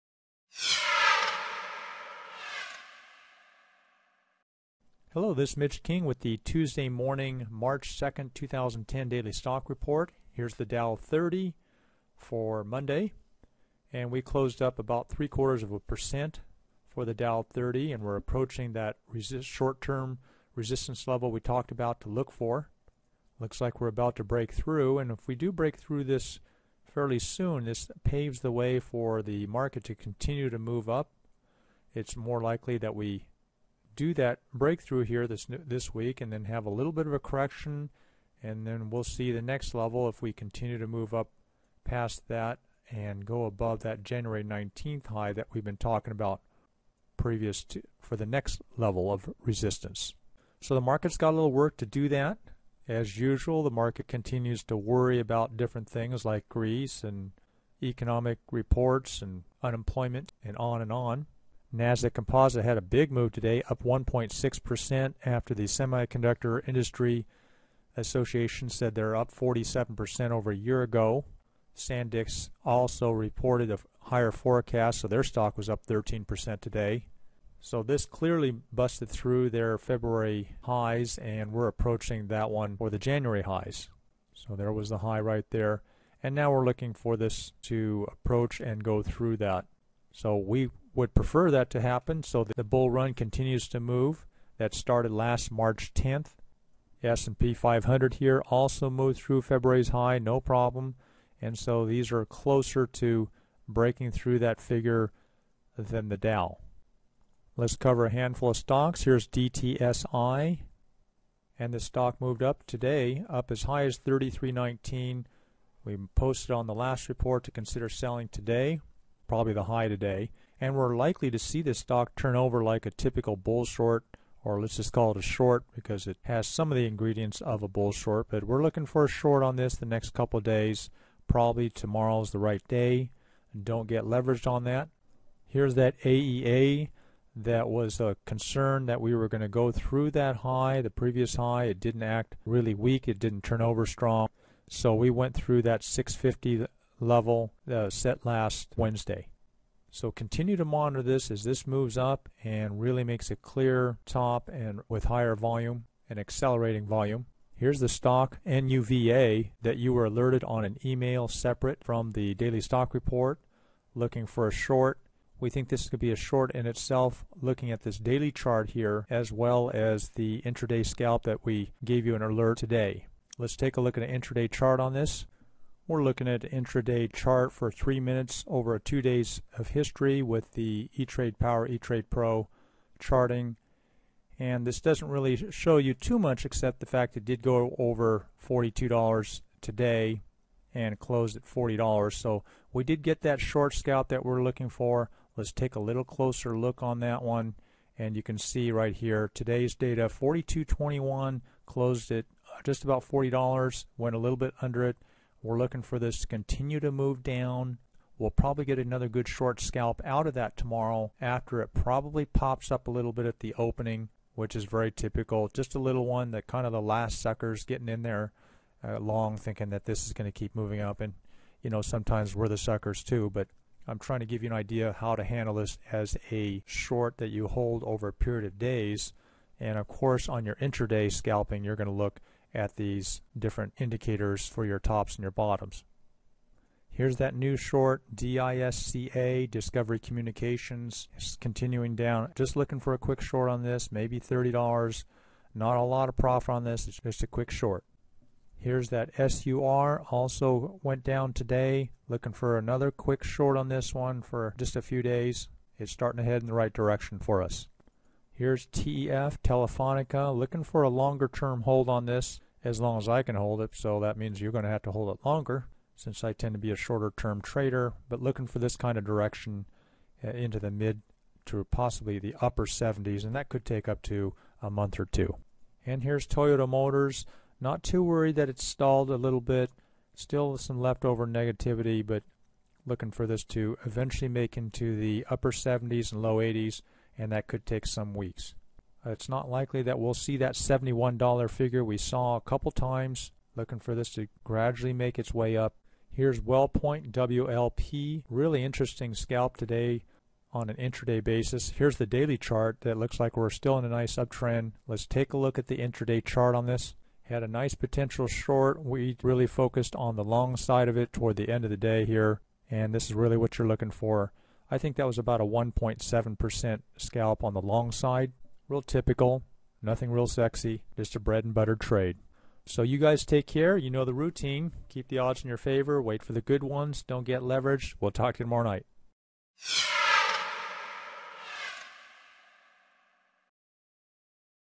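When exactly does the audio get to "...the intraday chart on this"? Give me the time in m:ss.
5:05.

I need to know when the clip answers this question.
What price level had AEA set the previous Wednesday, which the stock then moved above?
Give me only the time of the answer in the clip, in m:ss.
2:25.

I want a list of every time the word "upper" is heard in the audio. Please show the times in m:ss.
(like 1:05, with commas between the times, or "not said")
4:32, 4:45.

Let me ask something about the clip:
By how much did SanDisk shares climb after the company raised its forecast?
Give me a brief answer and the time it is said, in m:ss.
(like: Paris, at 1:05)
13%, at 1:15.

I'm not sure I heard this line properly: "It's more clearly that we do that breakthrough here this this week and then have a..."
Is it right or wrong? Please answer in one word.
wrong.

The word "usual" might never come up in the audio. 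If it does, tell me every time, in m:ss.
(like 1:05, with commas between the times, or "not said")
0:53.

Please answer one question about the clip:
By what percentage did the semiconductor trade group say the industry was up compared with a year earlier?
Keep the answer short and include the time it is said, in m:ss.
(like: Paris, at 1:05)
47%, at 1:09.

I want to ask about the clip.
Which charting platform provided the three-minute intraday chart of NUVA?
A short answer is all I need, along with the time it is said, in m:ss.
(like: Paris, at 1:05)
E-Trade Pro, at 3:01.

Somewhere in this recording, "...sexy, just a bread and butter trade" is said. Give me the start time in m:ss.
5:20.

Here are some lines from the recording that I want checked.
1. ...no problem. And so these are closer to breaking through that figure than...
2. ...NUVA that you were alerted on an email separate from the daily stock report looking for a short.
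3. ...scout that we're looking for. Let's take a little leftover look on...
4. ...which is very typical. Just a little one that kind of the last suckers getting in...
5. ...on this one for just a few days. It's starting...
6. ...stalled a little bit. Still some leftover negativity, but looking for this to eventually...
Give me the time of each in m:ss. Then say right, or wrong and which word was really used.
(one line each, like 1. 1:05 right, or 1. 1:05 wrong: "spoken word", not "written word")
1. 1:40 right
2. 2:38 right
3. 3:13 wrong: "closer", not "leftover"
4. 3:34 right
5. 4:13 right
6. 4:38 right.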